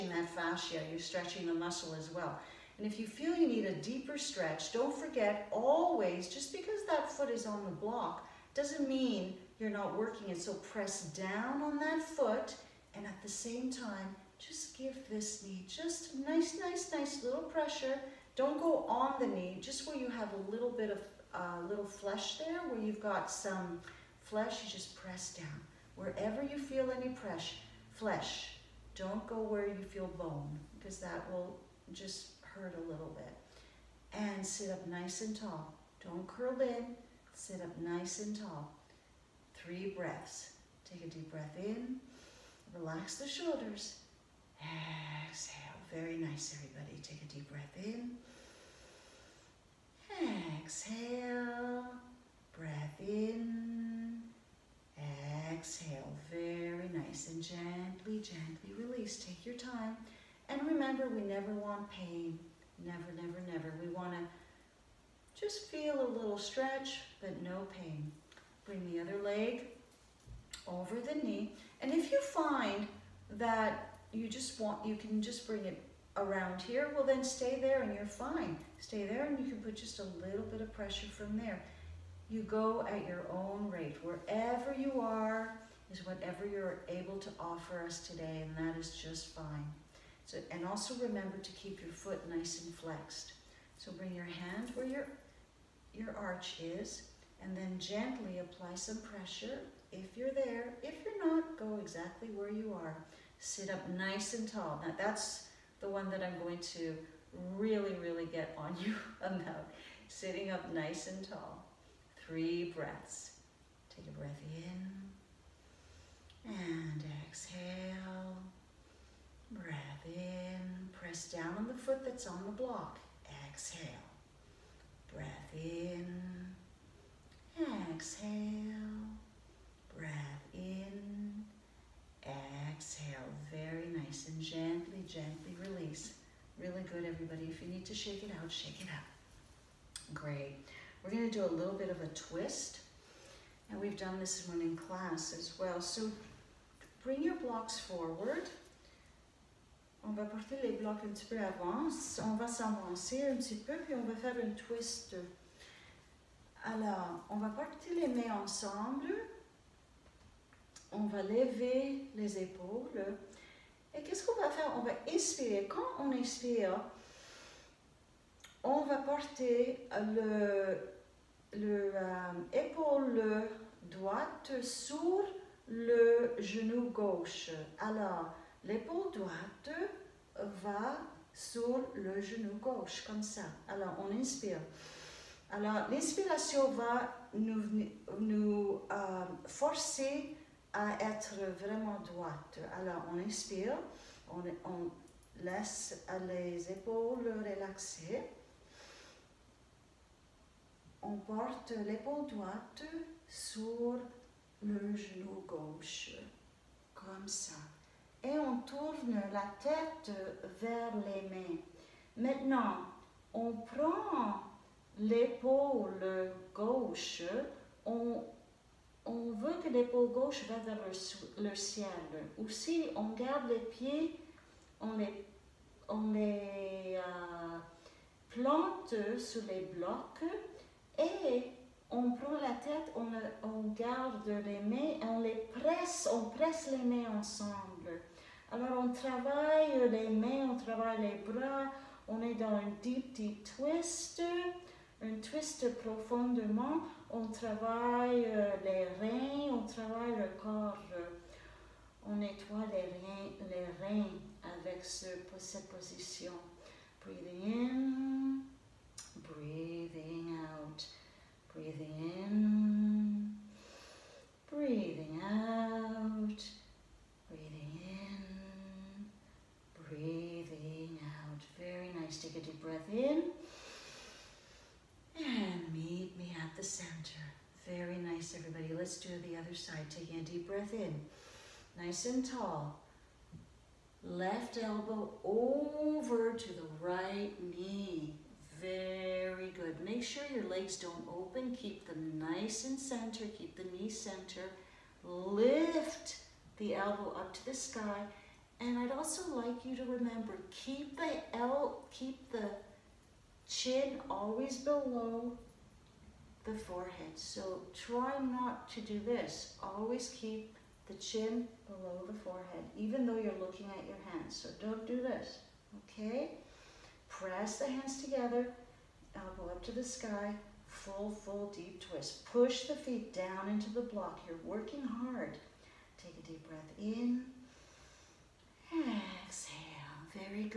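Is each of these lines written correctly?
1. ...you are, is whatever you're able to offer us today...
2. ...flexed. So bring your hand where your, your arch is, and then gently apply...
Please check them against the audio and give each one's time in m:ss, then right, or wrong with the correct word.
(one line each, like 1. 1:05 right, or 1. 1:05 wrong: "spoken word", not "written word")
1. 1:24 right
2. 1:32 right.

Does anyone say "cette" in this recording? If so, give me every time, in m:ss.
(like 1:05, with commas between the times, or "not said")
4:14.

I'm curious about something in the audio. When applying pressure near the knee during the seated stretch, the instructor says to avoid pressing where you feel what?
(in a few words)
Bone.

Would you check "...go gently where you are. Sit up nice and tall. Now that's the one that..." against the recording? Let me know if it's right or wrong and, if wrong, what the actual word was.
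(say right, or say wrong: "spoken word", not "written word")
wrong: "exactly", not "gently".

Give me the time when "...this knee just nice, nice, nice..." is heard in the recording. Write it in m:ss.
0:15.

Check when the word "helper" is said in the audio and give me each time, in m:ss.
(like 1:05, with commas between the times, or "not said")
not said.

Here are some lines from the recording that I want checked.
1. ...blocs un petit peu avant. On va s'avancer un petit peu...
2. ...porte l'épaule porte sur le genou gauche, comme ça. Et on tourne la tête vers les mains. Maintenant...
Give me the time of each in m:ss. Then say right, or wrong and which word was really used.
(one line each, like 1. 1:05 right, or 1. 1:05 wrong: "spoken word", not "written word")
1. 2:30 right
2. 3:21 wrong: "droite", not "porte".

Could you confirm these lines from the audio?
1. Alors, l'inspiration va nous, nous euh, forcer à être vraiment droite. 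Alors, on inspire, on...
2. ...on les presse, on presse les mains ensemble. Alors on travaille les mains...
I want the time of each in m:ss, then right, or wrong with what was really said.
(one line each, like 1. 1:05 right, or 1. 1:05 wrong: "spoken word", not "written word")
1. 3:05 right
2. 3:55 right.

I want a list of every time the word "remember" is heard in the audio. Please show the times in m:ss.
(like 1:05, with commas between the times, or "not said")
1:00, 1:30, 4:59.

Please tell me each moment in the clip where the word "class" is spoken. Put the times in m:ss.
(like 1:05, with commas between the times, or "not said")
2:24.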